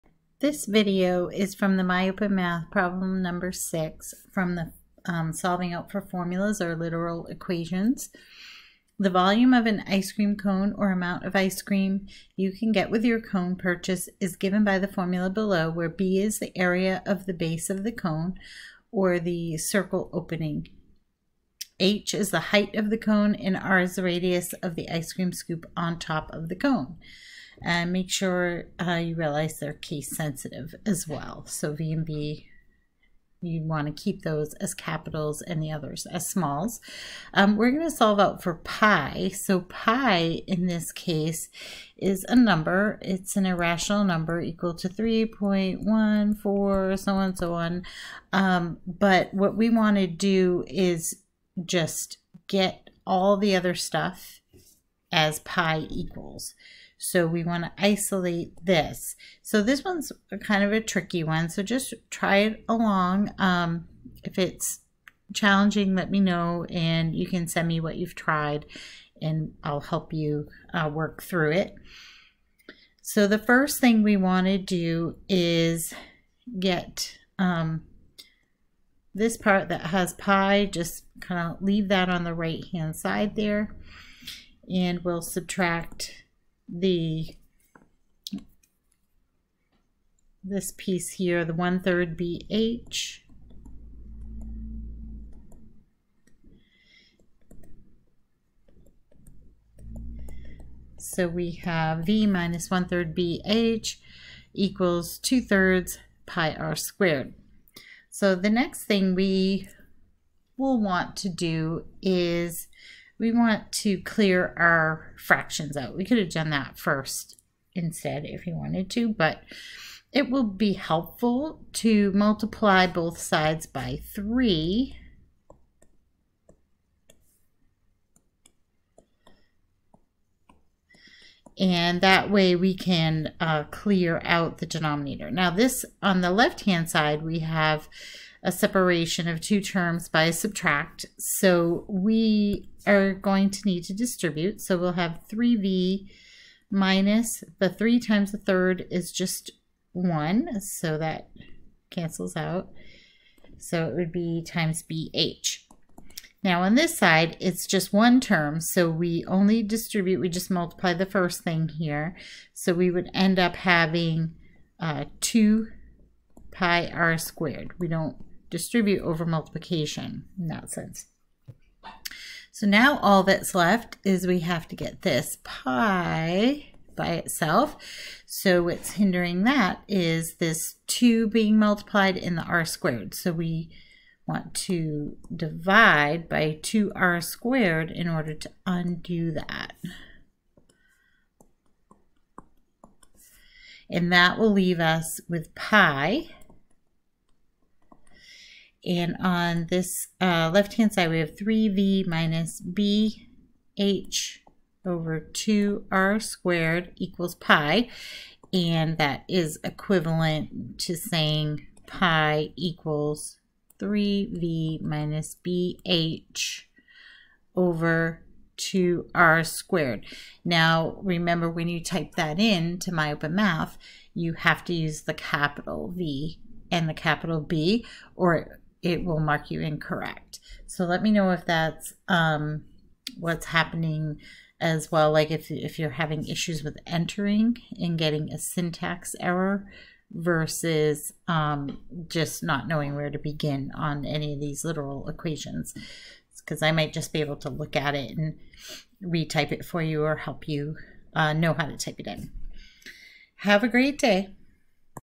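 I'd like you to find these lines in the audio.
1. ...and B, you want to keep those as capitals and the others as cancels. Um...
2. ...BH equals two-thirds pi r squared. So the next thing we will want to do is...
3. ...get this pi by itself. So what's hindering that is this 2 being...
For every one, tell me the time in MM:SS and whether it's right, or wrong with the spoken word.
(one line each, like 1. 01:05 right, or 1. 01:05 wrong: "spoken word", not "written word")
1. 00:31 wrong: "smalls", not "cancels"
2. 01:43 right
3. 02:54 right.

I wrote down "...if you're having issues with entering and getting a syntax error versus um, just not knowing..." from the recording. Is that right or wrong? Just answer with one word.
right.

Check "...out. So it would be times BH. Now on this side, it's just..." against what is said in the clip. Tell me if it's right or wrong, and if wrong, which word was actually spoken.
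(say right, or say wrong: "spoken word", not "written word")
right.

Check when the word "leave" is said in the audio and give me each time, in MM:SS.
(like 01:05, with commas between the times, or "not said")
01:21, 03:14.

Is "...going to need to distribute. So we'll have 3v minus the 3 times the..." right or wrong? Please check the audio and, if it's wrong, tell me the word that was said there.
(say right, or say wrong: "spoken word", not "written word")
right.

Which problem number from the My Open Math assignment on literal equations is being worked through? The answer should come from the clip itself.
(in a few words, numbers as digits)
6.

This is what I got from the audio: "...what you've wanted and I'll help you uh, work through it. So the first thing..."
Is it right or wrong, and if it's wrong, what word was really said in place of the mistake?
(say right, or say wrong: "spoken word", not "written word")
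wrong: "tried", not "wanted".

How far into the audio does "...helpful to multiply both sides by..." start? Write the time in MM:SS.
02:00.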